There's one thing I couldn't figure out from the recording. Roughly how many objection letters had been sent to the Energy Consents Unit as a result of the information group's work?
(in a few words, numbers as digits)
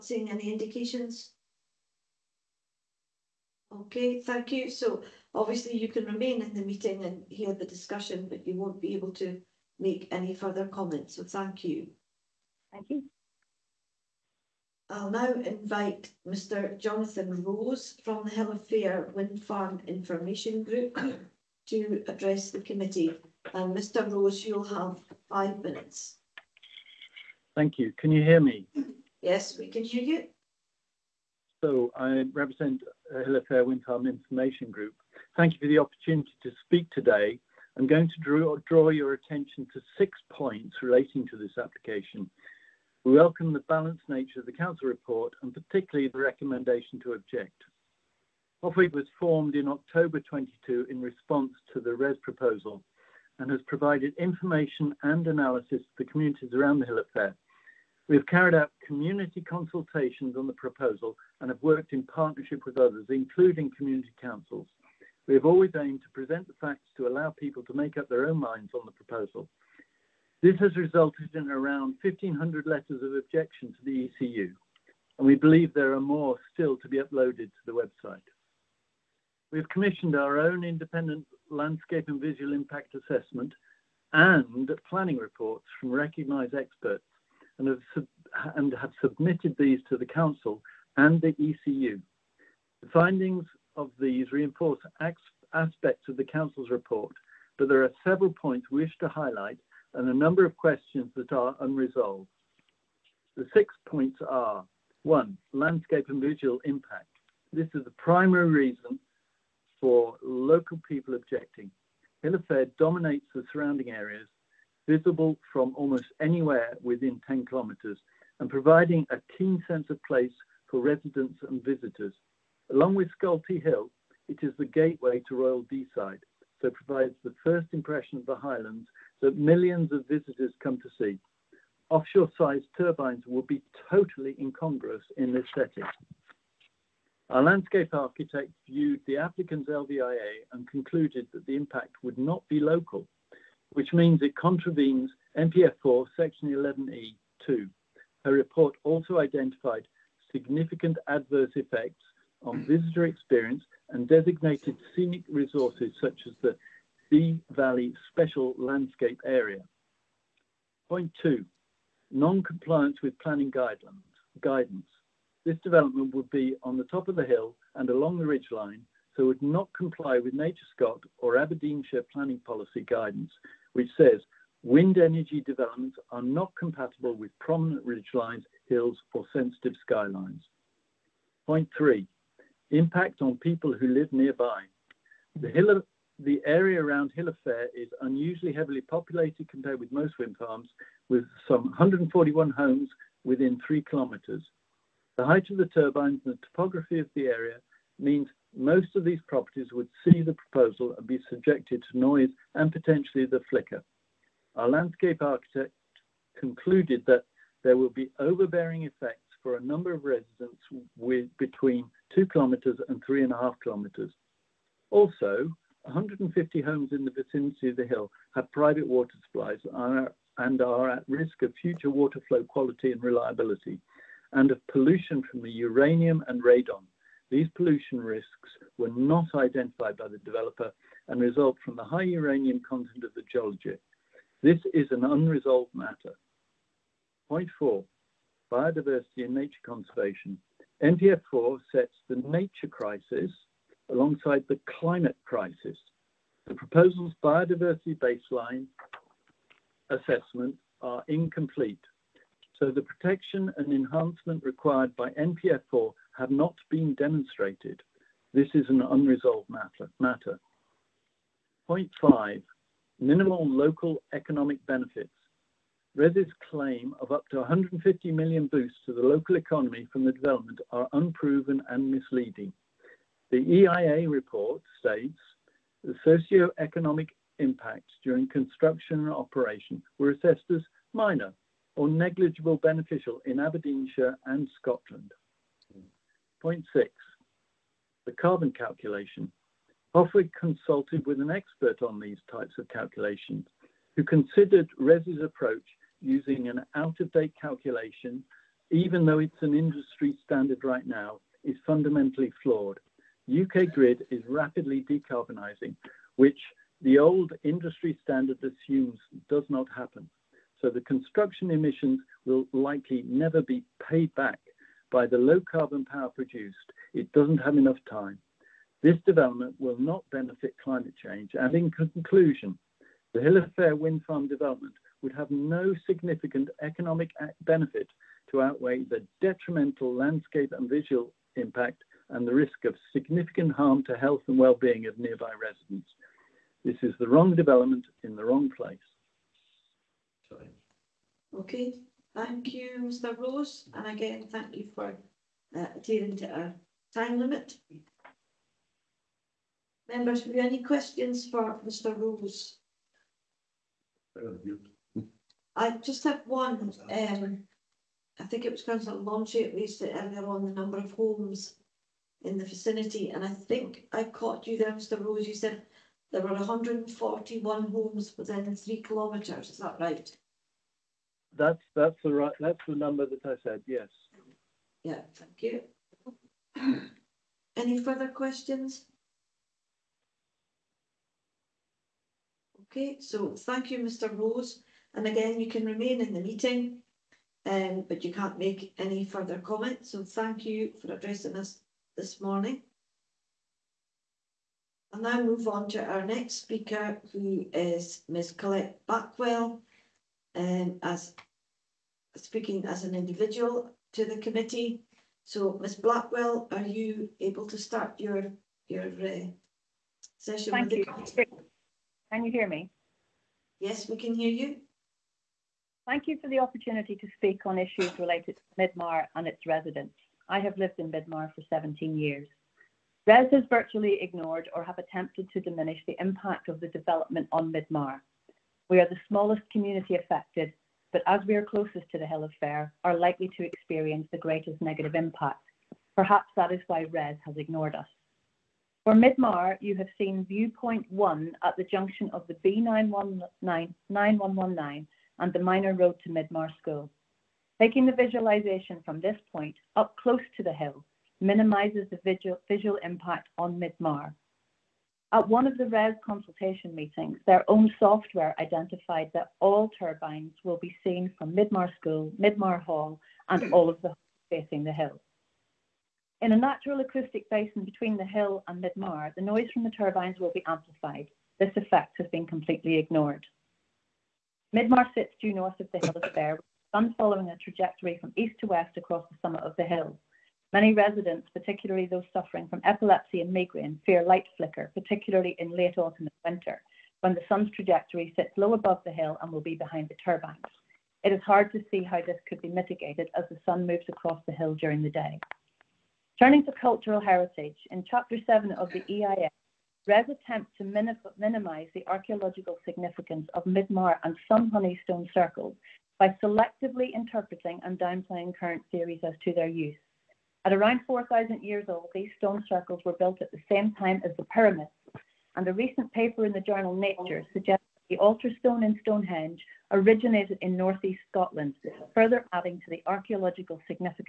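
1,500.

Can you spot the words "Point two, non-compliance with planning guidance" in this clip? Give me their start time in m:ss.
2:40.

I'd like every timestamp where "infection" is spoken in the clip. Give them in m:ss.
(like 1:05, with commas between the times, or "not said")
not said.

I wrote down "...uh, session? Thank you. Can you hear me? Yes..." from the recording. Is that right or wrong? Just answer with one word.
right.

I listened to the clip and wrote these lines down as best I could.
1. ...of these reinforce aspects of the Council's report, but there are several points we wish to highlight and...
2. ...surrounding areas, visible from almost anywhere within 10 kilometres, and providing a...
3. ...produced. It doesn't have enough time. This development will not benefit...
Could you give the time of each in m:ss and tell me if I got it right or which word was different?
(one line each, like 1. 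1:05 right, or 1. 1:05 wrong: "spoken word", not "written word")
1. 1:33 right
2. 1:53 right
3. 5:16 right.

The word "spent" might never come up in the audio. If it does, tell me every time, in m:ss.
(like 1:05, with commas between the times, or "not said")
not said.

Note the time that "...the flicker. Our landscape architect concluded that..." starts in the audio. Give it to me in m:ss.
3:23.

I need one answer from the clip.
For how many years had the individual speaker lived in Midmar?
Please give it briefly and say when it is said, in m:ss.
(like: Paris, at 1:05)
17, at 7:01.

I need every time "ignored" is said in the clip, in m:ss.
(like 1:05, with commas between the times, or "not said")
7:04, 7:17, 7:52.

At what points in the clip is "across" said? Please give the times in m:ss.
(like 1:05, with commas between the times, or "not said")
7:58, 8:13.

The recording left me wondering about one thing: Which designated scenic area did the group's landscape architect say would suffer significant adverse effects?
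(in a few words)
Dee Valley Special Landscape Area.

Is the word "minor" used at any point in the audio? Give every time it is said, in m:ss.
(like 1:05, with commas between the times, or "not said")
4:40, 7:25.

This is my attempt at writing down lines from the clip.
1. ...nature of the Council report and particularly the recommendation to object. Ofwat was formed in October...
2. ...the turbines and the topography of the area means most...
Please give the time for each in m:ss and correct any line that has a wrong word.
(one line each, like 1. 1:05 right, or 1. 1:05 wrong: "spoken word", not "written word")
1. 0:44 right
2. 3:15 right.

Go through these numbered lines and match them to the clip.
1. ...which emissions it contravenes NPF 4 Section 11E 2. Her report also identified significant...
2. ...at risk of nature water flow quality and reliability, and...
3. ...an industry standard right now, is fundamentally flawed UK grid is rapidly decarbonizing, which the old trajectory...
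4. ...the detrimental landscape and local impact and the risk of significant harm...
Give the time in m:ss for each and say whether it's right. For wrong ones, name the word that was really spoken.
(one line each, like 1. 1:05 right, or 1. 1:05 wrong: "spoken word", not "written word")
1. 2:23 wrong: "means", not "emissions"
2. 3:40 wrong: "future", not "nature"
3. 4:59 wrong: "industry", not "trajectory"
4. 5:28 wrong: "visual", not "local".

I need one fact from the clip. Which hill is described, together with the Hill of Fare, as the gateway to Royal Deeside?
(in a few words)
Scolty Hill.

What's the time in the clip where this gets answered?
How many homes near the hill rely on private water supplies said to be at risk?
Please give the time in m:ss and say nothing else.
3:35.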